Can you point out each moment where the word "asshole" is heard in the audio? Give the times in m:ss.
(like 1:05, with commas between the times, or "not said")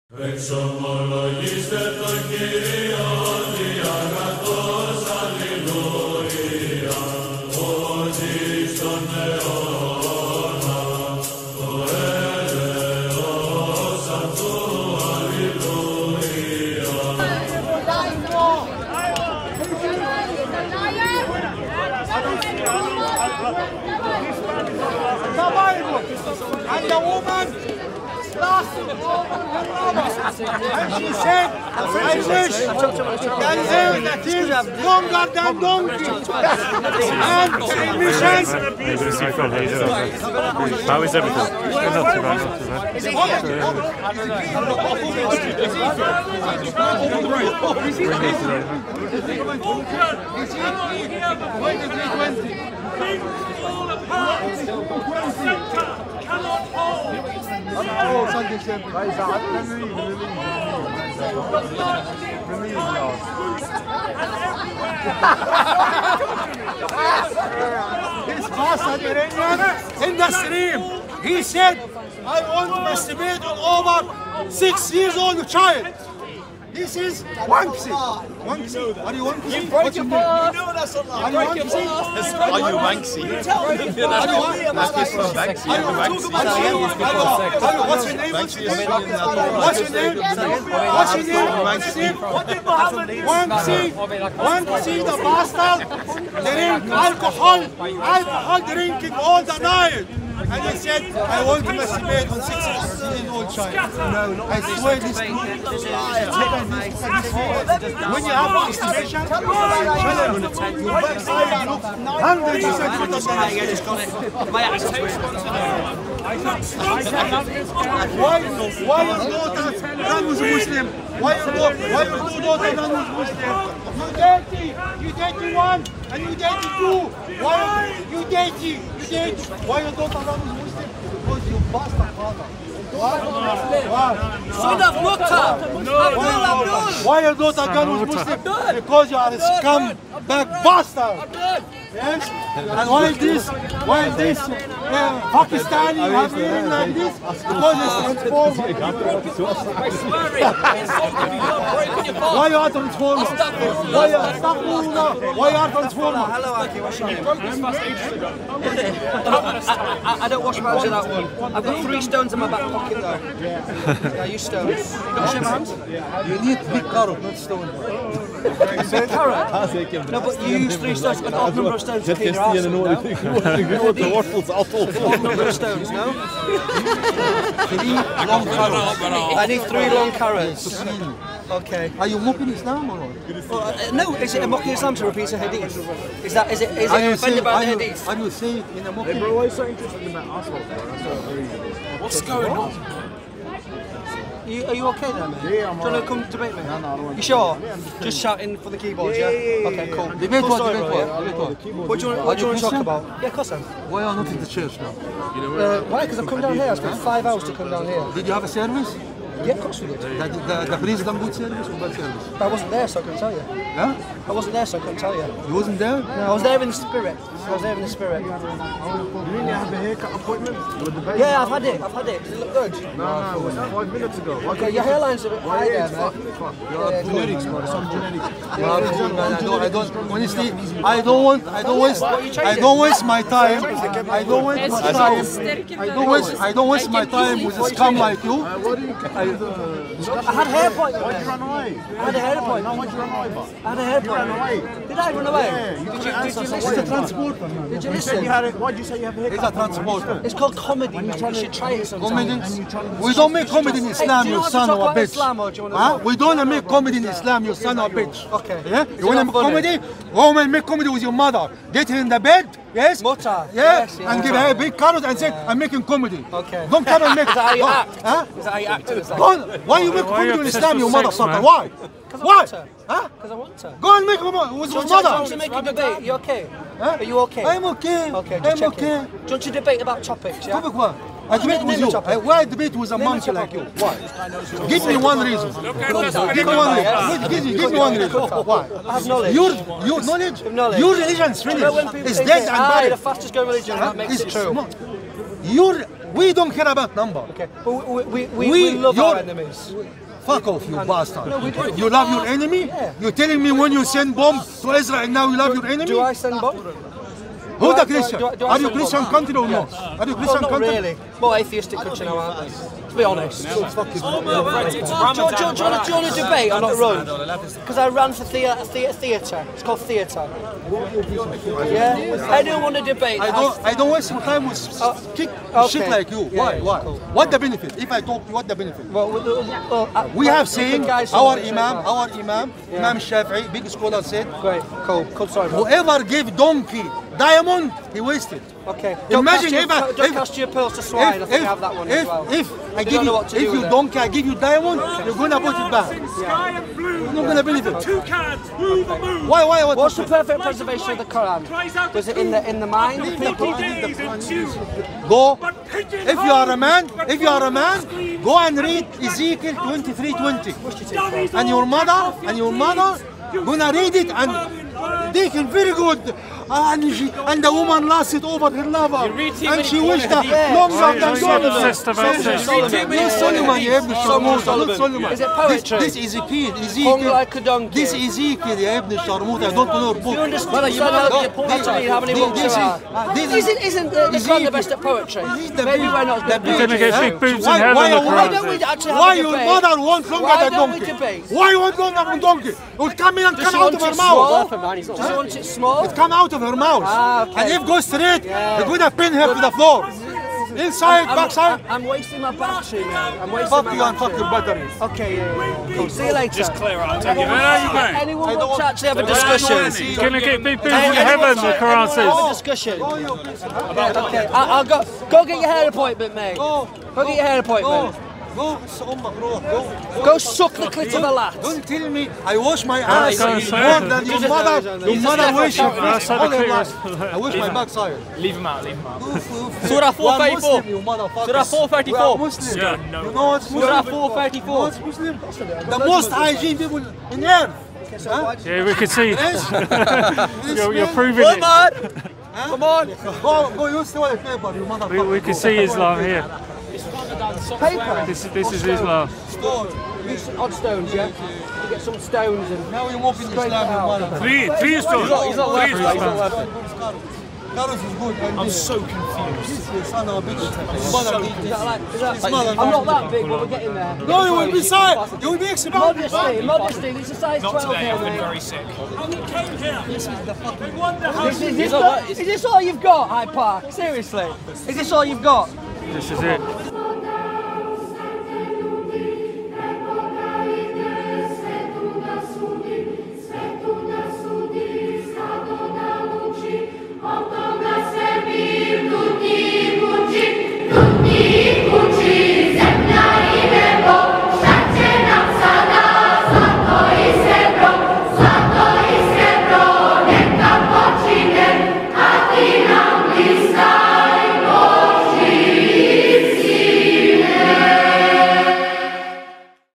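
3:10.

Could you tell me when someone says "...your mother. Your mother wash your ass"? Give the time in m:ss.
7:04.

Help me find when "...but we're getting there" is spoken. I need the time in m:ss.
7:43.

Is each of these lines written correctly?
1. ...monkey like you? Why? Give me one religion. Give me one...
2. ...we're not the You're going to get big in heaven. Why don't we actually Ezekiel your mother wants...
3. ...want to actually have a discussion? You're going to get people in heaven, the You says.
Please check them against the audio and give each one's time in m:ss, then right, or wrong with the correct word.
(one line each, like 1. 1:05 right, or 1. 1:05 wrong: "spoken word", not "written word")
1. 4:42 wrong: "reason", not "religion"
2. 6:25 wrong: "Why", not "Ezekiel"
3. 6:48 wrong: "Quran", not "You".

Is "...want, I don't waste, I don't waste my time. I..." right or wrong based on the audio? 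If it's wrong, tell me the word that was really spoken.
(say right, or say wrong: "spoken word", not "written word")
right.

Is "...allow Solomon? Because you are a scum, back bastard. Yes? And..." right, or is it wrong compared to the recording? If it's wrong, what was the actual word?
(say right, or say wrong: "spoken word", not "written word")
wrong: "Muslim", not "Solomon".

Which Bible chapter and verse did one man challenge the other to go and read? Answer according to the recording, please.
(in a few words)
Ezekiel 23:20.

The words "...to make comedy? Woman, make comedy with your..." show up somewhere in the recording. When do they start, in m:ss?
4:19.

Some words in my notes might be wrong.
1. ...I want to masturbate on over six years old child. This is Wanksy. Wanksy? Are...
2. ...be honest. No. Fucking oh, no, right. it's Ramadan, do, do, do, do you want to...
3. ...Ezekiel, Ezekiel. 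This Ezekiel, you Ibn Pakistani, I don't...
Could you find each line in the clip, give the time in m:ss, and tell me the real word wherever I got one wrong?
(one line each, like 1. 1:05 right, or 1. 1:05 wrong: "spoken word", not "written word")
1. 1:12 right
2. 5:12 right
3. 6:16 wrong: "Sharmut", not "Pakistani".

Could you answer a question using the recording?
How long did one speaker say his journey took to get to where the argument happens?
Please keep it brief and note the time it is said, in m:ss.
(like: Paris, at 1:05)
5 hours, at 3:26.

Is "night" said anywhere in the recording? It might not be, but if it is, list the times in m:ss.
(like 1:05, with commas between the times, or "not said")
1:39.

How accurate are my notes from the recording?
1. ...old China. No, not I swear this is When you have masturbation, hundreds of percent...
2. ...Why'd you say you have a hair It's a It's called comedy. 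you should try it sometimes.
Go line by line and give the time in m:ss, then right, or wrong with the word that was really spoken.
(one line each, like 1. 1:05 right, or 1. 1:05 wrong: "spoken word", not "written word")
1. 1:43 right
2. 4:08 right.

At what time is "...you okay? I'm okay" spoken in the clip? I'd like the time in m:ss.
4:37.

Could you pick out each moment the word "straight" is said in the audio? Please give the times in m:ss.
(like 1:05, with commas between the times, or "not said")
6:37.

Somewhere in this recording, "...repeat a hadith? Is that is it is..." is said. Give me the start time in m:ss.
3:05.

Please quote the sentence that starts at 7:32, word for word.
Now you're walking the Islam Three, three stones.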